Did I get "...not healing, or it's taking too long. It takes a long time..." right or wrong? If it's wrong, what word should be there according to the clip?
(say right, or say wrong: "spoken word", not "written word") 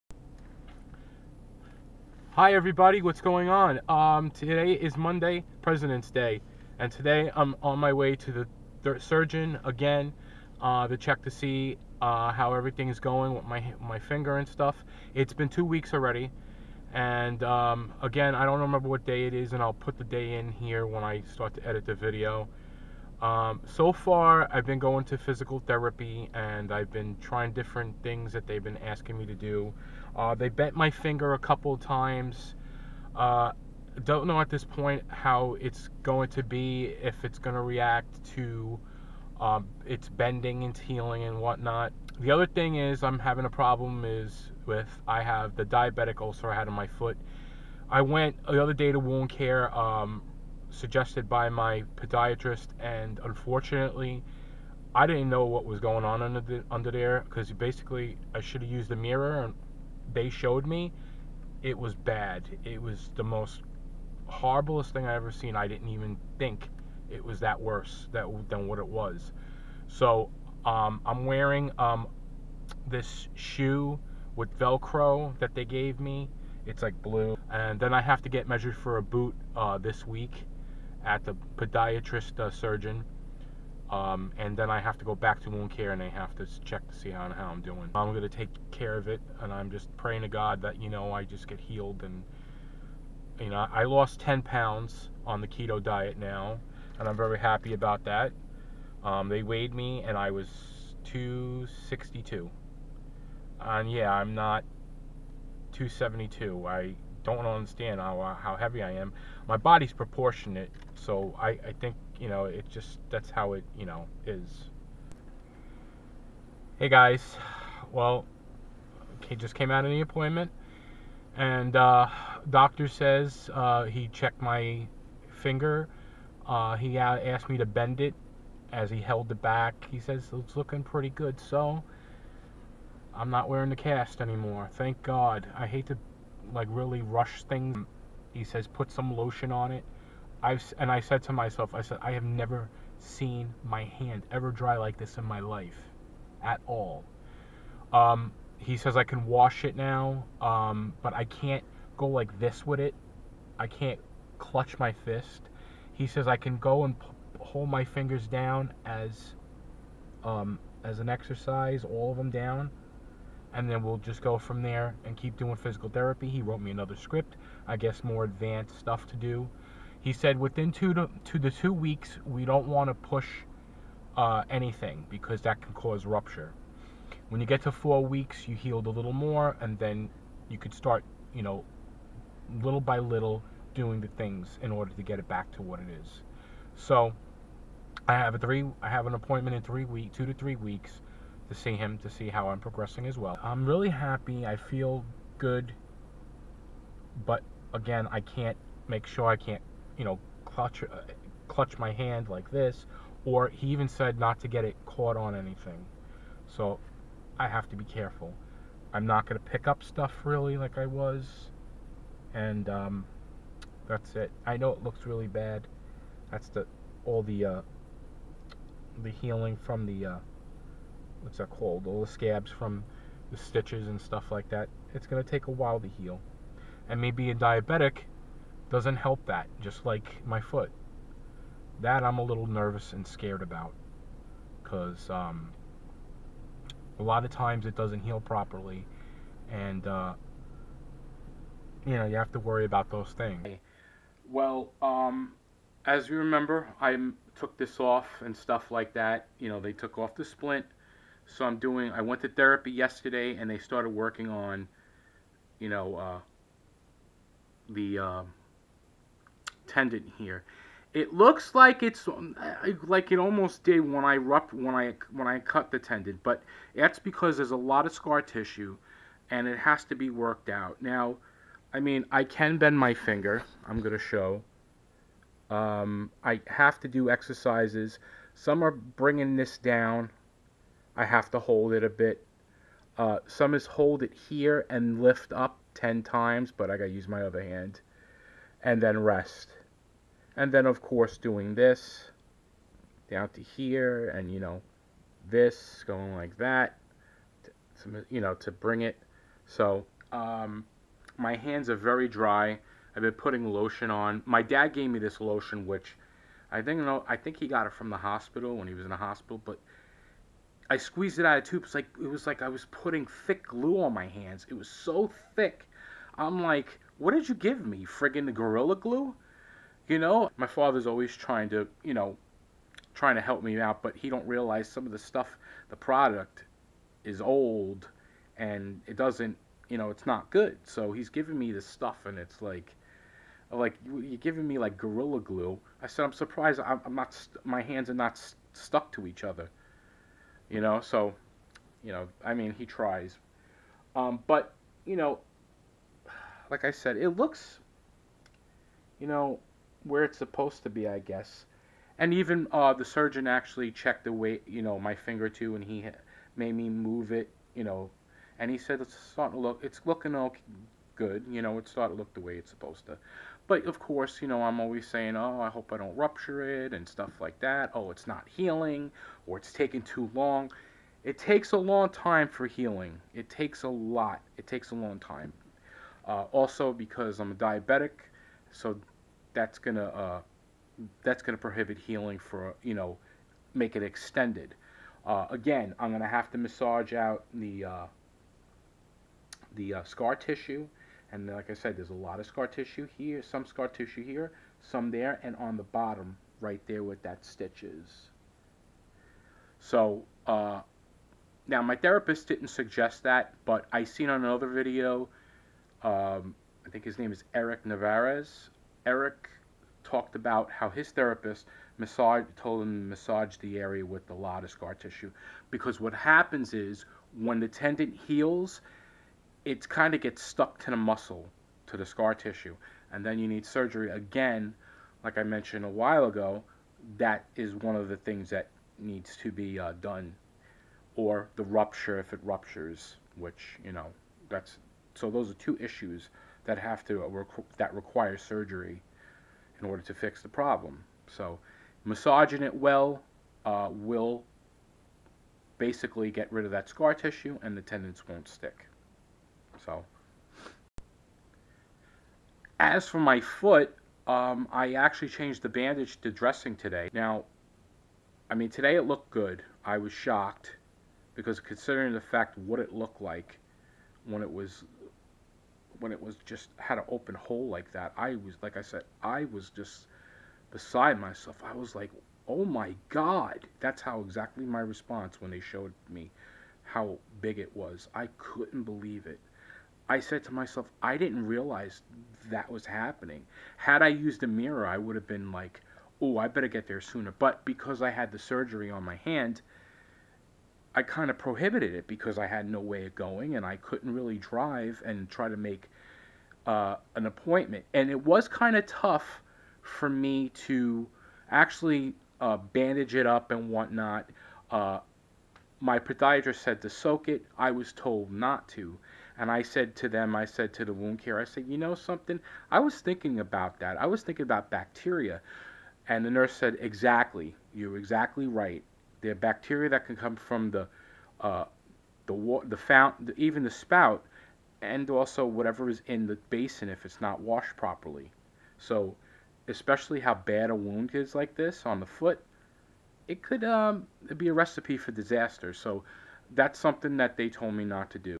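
right.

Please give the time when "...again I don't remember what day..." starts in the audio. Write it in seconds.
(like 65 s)
18 s.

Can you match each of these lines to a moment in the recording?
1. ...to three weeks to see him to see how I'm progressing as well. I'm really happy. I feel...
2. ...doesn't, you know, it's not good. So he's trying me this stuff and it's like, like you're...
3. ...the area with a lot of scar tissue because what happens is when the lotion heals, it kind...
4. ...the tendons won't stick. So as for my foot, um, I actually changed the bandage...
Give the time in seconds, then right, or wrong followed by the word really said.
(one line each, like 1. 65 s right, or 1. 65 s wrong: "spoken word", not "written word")
1. 190 s right
2. 328 s wrong: "giving", not "trying"
3. 413 s wrong: "tendon", not "lotion"
4. 447 s right.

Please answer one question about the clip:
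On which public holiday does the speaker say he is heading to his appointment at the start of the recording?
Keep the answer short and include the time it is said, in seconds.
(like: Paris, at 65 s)
President's Day, at 5 s.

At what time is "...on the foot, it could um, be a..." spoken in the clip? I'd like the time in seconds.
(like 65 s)
531 s.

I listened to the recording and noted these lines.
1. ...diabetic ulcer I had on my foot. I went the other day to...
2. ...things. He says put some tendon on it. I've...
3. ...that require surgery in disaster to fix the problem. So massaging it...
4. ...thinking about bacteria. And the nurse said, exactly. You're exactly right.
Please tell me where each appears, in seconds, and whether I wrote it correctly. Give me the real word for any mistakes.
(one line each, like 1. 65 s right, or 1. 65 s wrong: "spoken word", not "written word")
1. 45 s right
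2. 137 s wrong: "lotion", not "tendon"
3. 437 s wrong: "order", not "disaster"
4. 514 s right.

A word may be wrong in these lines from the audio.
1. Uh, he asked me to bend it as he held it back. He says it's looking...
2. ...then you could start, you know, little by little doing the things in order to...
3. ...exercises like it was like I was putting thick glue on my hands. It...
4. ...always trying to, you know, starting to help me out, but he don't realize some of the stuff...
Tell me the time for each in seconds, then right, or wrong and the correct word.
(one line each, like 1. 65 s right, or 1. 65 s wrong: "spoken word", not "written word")
1. 126 s right
2. 179 s right
3. 311 s wrong: "tubes", not "exercises"
4. 320 s wrong: "trying", not "starting".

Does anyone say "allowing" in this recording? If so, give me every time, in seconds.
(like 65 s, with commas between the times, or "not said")
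not said.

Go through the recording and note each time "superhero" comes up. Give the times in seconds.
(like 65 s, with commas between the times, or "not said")
not said.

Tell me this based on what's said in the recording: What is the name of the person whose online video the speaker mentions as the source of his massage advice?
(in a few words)
Eric Navarez.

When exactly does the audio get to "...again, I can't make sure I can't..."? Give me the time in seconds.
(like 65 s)
197 s.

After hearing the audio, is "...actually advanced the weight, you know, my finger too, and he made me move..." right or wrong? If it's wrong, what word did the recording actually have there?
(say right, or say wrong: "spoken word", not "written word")
wrong: "checked", not "advanced".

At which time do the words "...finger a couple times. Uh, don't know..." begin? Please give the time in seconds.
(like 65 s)
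30 s.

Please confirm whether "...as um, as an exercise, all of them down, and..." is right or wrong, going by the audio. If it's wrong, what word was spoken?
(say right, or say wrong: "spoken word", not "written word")
right.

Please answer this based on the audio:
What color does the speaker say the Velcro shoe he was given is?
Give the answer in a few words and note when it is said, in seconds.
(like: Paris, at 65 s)
Blue, at 77 s.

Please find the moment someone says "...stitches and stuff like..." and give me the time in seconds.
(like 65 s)
223 s.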